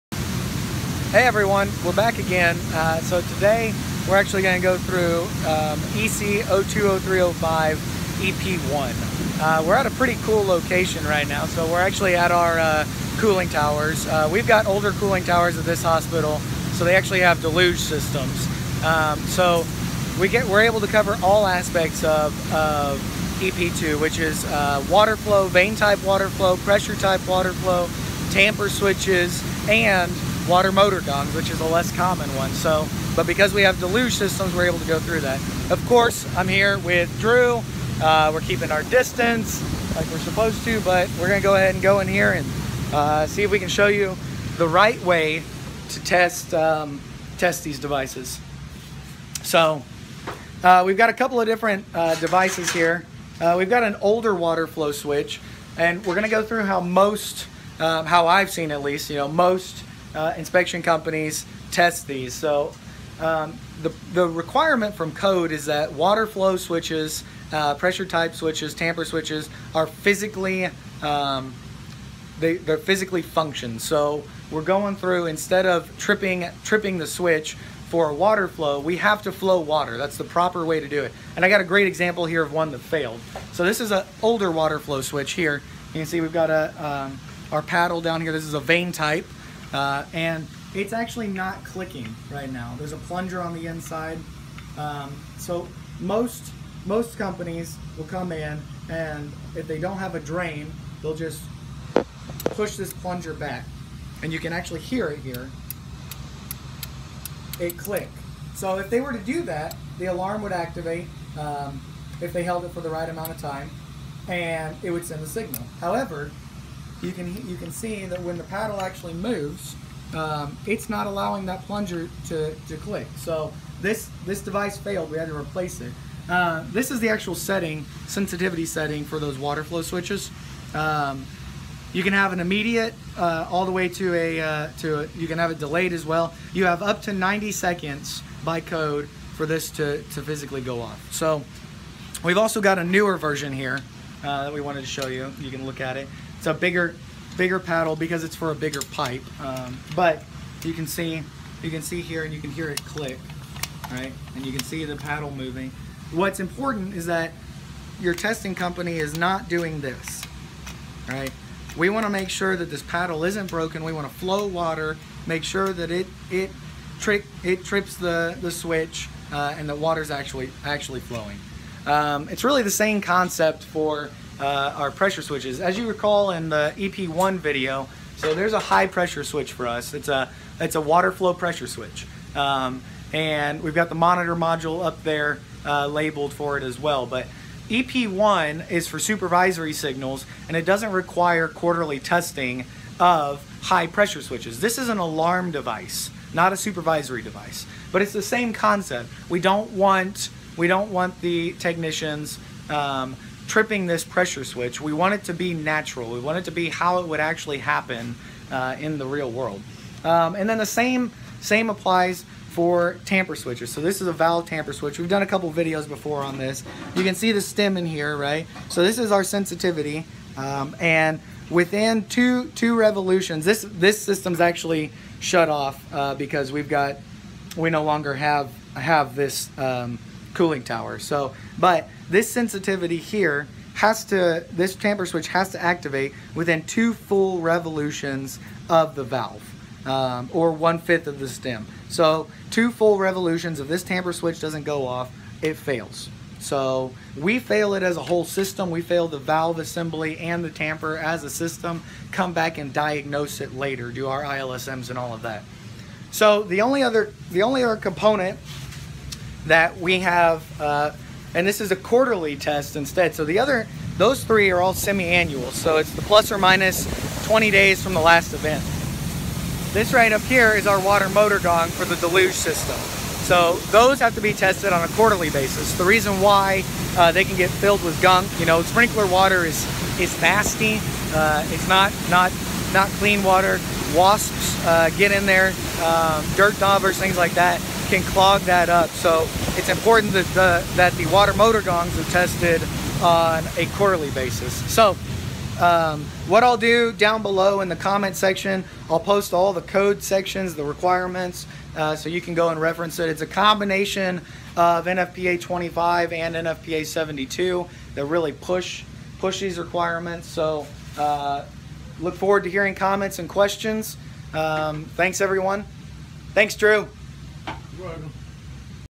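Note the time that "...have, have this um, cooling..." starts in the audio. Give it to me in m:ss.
3:48.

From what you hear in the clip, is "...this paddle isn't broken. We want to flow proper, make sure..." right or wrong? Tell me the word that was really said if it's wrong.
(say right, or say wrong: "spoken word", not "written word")
wrong: "water", not "proper".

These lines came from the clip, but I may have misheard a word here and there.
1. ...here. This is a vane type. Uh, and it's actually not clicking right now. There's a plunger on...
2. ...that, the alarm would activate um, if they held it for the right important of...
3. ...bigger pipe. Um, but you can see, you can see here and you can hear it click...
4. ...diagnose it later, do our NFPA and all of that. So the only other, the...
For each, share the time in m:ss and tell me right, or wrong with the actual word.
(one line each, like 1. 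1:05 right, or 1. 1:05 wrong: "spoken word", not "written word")
1. 1:28 right
2. 1:49 wrong: "amount", not "important"
3. 2:28 right
4. 4:12 wrong: "ILSMs", not "NFPA".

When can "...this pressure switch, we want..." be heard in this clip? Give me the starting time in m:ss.
3:23.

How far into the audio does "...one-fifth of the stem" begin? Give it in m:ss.
4:00.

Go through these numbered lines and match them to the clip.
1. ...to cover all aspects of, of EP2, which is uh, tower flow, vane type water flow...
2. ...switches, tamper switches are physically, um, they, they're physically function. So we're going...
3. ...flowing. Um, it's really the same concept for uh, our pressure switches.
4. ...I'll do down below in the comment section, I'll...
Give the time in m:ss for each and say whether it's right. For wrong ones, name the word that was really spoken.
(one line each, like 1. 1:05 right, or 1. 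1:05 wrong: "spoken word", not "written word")
1. 0:20 wrong: "water", not "tower"
2. 1:08 right
3. 2:51 right
4. 4:56 right.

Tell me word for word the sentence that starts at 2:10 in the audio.
Um, you can have an immediate uh, all the way to a, uh, to a, you can have it delayed as well.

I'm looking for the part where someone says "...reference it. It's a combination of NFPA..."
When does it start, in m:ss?
5:02.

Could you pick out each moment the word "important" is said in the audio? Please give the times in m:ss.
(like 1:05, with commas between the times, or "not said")
2:36, 4:49.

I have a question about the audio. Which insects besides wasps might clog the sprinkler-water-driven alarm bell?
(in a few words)
dirt daubers.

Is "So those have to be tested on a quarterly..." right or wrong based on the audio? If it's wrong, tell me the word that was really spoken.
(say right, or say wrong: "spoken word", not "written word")
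right.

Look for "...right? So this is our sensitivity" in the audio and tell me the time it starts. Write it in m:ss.
3:38.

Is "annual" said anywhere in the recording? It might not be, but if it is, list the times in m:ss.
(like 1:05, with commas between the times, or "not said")
4:24.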